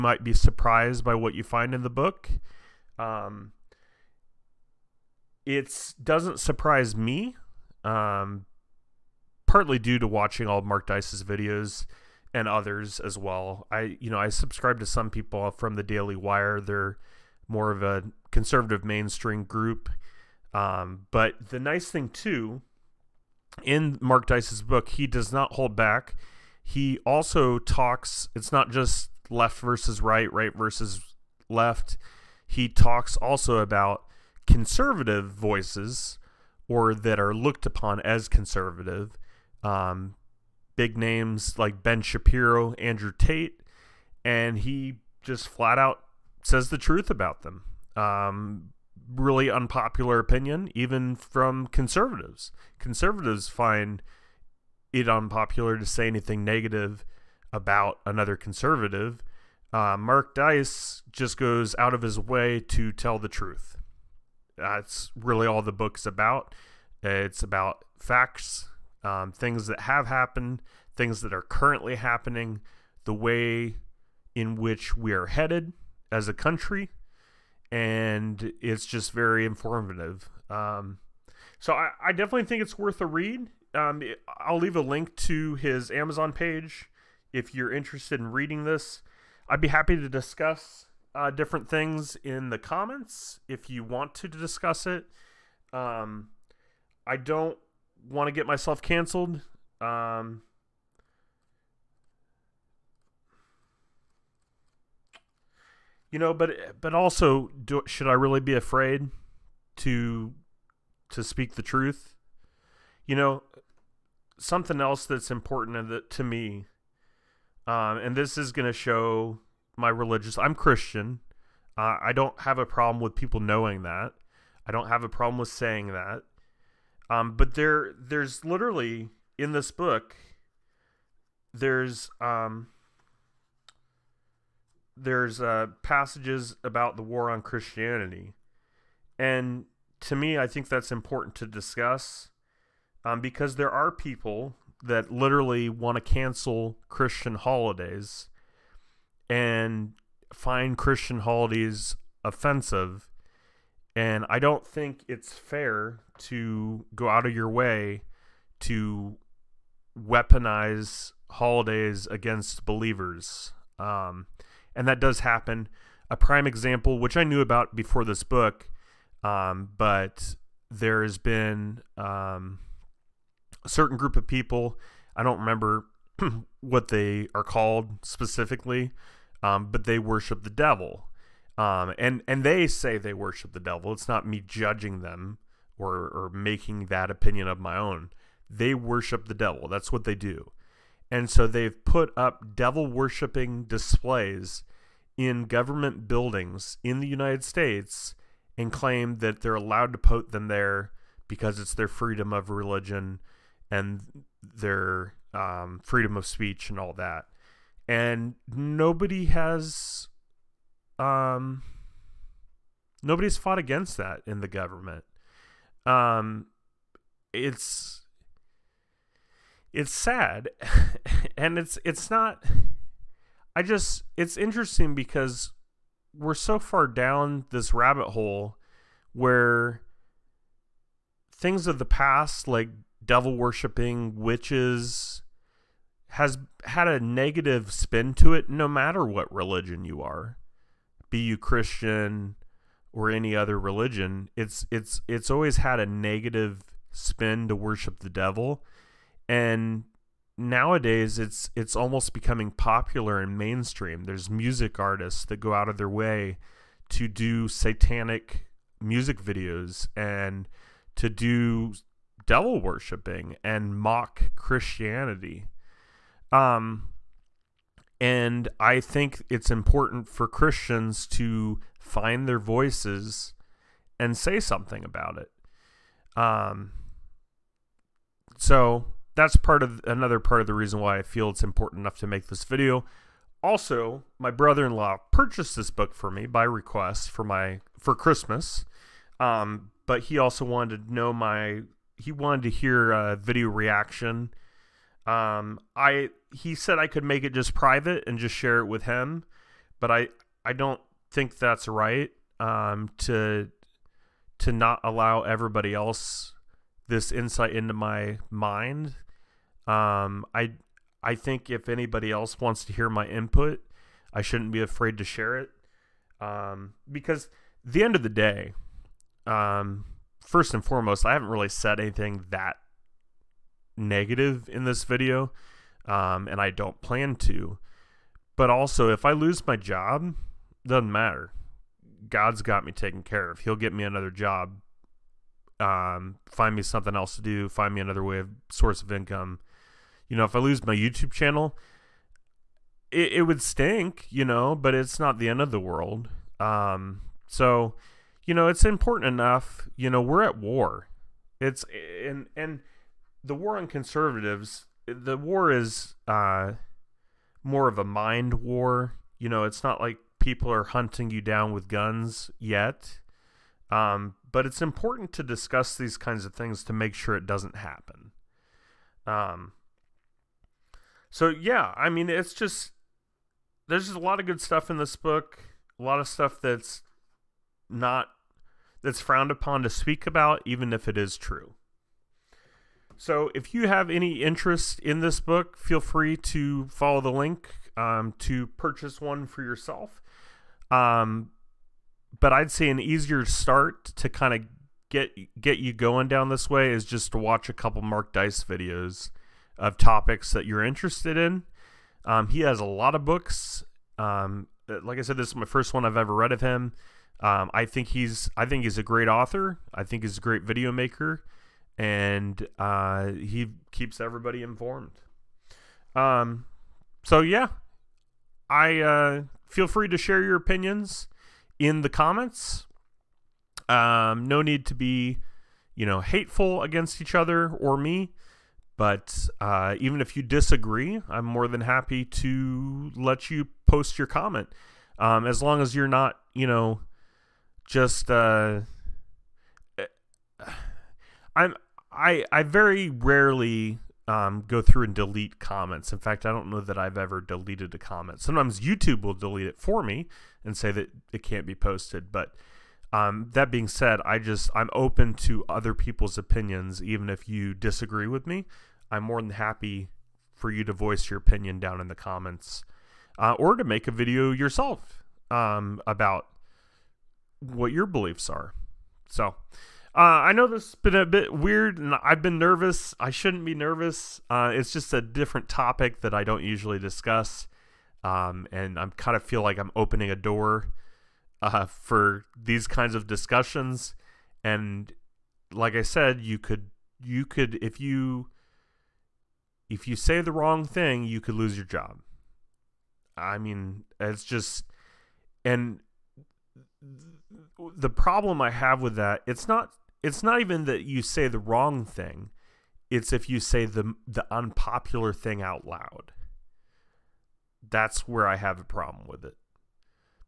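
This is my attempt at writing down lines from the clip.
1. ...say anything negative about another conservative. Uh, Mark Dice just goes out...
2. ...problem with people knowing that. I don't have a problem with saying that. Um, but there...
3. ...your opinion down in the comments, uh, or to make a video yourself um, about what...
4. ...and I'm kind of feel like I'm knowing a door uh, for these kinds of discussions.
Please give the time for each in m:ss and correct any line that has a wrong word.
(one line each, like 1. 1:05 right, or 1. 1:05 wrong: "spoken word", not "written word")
1. 0:55 right
2. 2:02 right
3. 7:41 right
4. 7:58 wrong: "opening", not "knowing".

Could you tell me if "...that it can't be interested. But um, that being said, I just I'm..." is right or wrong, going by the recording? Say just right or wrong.
wrong.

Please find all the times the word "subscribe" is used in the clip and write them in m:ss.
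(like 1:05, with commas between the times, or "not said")
0:14.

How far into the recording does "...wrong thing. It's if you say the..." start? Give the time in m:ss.
8:21.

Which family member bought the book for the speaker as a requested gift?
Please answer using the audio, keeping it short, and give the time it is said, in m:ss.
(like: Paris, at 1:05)
Brother-in-law, at 4:44.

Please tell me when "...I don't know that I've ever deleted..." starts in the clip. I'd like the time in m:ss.
7:26.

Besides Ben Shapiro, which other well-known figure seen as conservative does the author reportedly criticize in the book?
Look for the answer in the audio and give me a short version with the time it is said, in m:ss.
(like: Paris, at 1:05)
Andrew Tate, at 0:42.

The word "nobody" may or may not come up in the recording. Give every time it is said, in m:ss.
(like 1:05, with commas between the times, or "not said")
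3:28, 3:33.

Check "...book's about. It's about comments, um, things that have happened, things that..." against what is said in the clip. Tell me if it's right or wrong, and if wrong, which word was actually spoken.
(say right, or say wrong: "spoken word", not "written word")
wrong: "facts", not "comments".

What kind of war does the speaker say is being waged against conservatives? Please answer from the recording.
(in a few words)
A mind war.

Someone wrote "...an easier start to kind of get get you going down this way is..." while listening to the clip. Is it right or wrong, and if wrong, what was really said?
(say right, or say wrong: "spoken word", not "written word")
right.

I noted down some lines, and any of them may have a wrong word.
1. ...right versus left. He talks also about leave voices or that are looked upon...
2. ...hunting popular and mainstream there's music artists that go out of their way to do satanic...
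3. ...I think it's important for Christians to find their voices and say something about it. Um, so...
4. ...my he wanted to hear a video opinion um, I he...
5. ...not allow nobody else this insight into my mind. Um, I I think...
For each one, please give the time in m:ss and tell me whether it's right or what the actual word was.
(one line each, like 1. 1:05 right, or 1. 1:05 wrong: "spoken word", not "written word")
1. 0:30 wrong: "conservative", not "leave"
2. 4:12 wrong: "becoming", not "hunting"
3. 4:28 right
4. 4:51 wrong: "reaction", not "opinion"
5. 5:04 wrong: "everybody", not "nobody".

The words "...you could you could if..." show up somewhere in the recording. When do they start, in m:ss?
8:06.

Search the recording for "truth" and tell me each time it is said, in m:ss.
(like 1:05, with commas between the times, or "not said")
0:46, 1:03, 1:51.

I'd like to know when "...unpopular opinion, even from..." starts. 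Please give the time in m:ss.
0:49.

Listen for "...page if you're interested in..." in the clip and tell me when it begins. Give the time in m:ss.
1:26.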